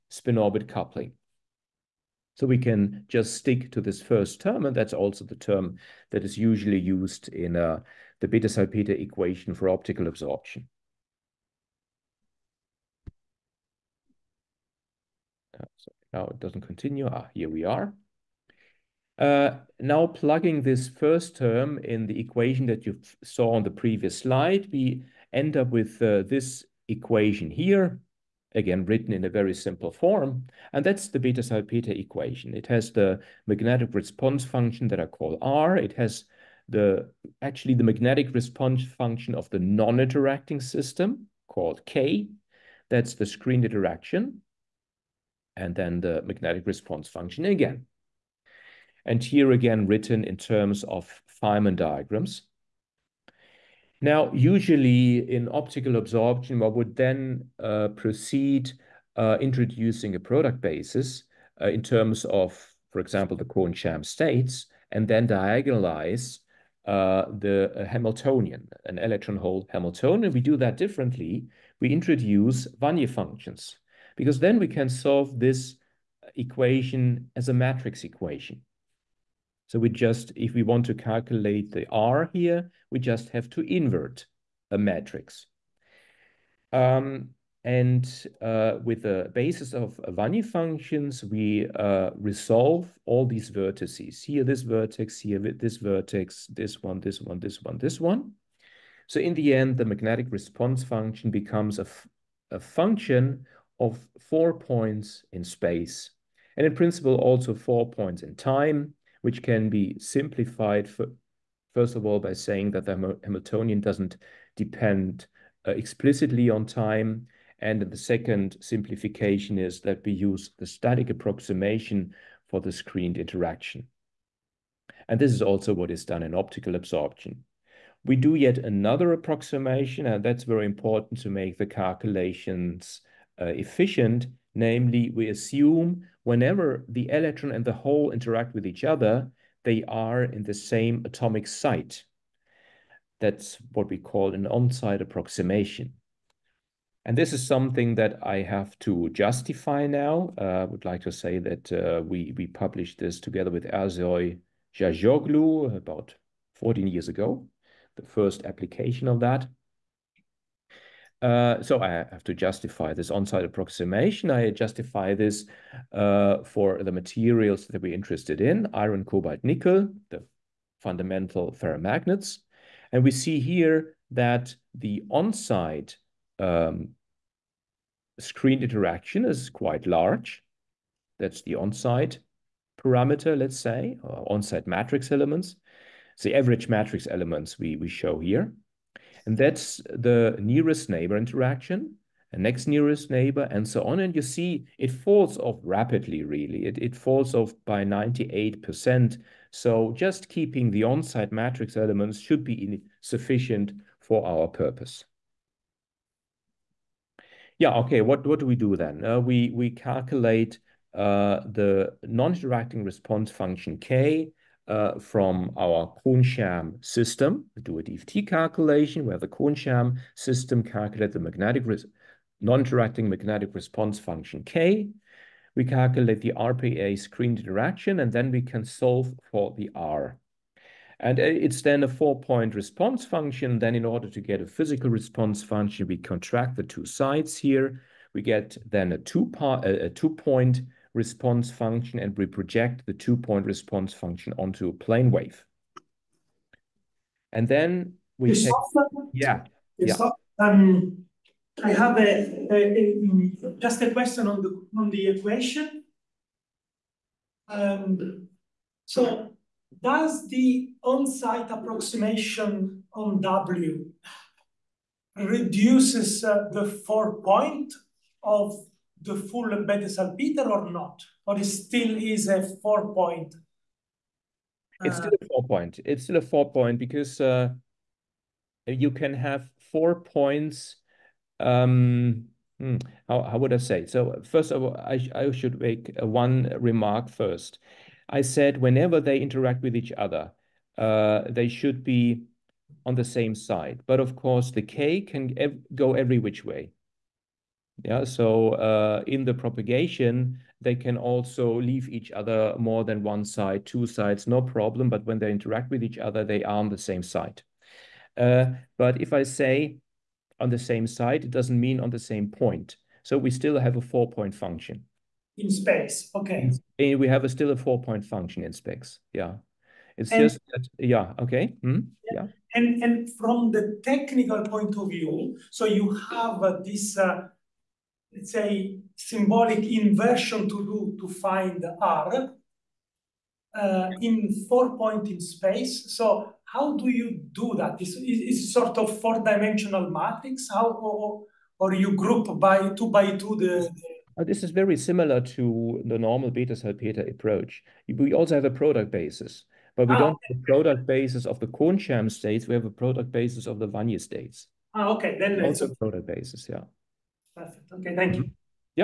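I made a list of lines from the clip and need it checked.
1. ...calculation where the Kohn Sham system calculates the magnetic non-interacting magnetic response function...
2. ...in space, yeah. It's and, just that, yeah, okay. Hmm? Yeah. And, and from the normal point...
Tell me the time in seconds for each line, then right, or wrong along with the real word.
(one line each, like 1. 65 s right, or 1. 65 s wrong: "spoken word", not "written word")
1. 218 s right
2. 318 s wrong: "technical", not "normal".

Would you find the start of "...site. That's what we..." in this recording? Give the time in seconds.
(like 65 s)
141 s.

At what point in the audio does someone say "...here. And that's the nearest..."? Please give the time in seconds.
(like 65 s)
188 s.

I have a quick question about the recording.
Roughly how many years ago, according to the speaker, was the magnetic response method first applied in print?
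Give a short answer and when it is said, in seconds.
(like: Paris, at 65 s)
14, at 156 s.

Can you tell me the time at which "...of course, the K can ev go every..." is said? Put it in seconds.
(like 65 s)
294 s.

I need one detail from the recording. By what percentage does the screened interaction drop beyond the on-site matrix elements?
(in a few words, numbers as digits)
98%.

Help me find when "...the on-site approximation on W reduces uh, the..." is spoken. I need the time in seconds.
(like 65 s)
260 s.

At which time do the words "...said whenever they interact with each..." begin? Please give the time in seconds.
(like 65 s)
288 s.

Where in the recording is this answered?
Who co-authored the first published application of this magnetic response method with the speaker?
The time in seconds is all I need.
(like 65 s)
153 s.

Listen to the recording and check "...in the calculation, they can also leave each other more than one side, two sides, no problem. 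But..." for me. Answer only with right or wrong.
wrong.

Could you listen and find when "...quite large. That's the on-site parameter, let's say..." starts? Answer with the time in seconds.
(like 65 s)
179 s.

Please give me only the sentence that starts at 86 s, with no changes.
Um, and uh, with the basis of Wannier functions, we uh, resolve all these vertices.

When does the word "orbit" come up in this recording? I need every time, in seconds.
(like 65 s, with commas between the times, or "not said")
0 s.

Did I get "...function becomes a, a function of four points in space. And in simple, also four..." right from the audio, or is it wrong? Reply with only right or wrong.
wrong.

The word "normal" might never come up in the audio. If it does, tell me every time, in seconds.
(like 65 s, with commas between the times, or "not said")
345 s.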